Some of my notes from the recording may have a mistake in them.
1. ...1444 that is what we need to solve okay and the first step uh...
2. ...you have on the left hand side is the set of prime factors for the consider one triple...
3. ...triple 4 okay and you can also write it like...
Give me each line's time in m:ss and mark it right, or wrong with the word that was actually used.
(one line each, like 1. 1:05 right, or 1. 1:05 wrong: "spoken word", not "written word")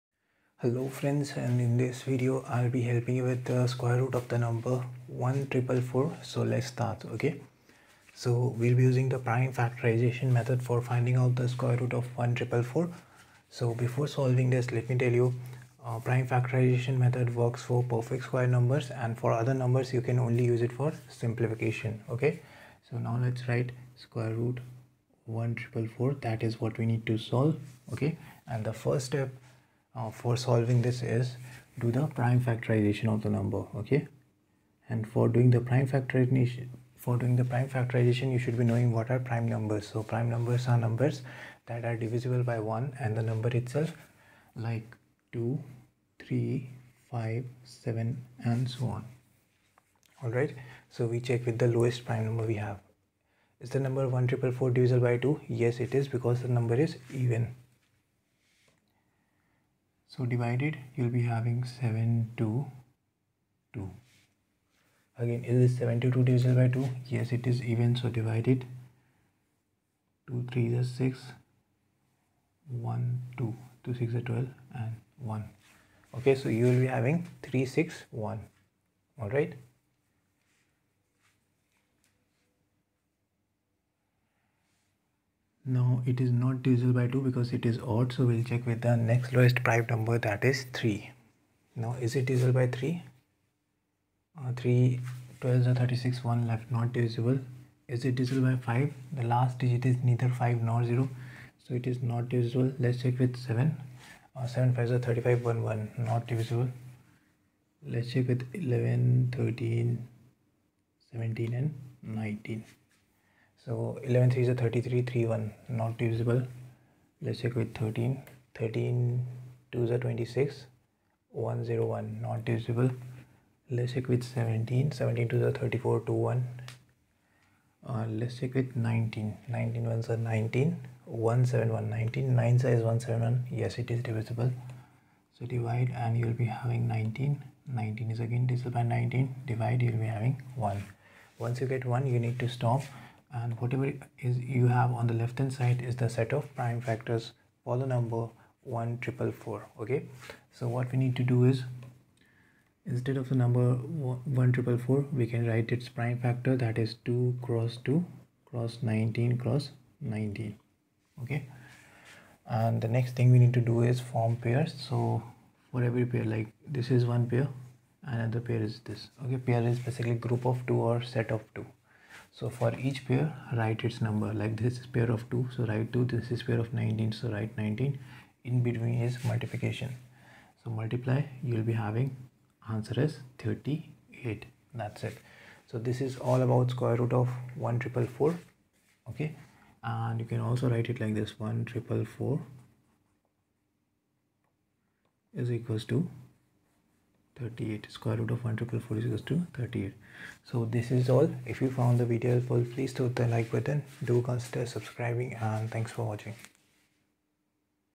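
1. 0:25 right
2. 2:24 wrong: "number", not "consider"
3. 3:07 right.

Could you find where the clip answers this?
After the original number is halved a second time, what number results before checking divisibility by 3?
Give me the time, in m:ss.
1:17.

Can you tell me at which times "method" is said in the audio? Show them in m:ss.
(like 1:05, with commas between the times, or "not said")
0:10, 0:16.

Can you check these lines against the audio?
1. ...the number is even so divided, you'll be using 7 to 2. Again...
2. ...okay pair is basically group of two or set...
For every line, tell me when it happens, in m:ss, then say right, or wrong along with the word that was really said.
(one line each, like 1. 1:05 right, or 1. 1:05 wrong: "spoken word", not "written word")
1. 0:56 wrong: "having", not "using"
2. 2:49 right.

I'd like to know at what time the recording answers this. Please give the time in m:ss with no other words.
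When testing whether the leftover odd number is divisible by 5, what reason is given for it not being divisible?
1:39.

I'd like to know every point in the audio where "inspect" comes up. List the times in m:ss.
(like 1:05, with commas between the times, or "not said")
not said.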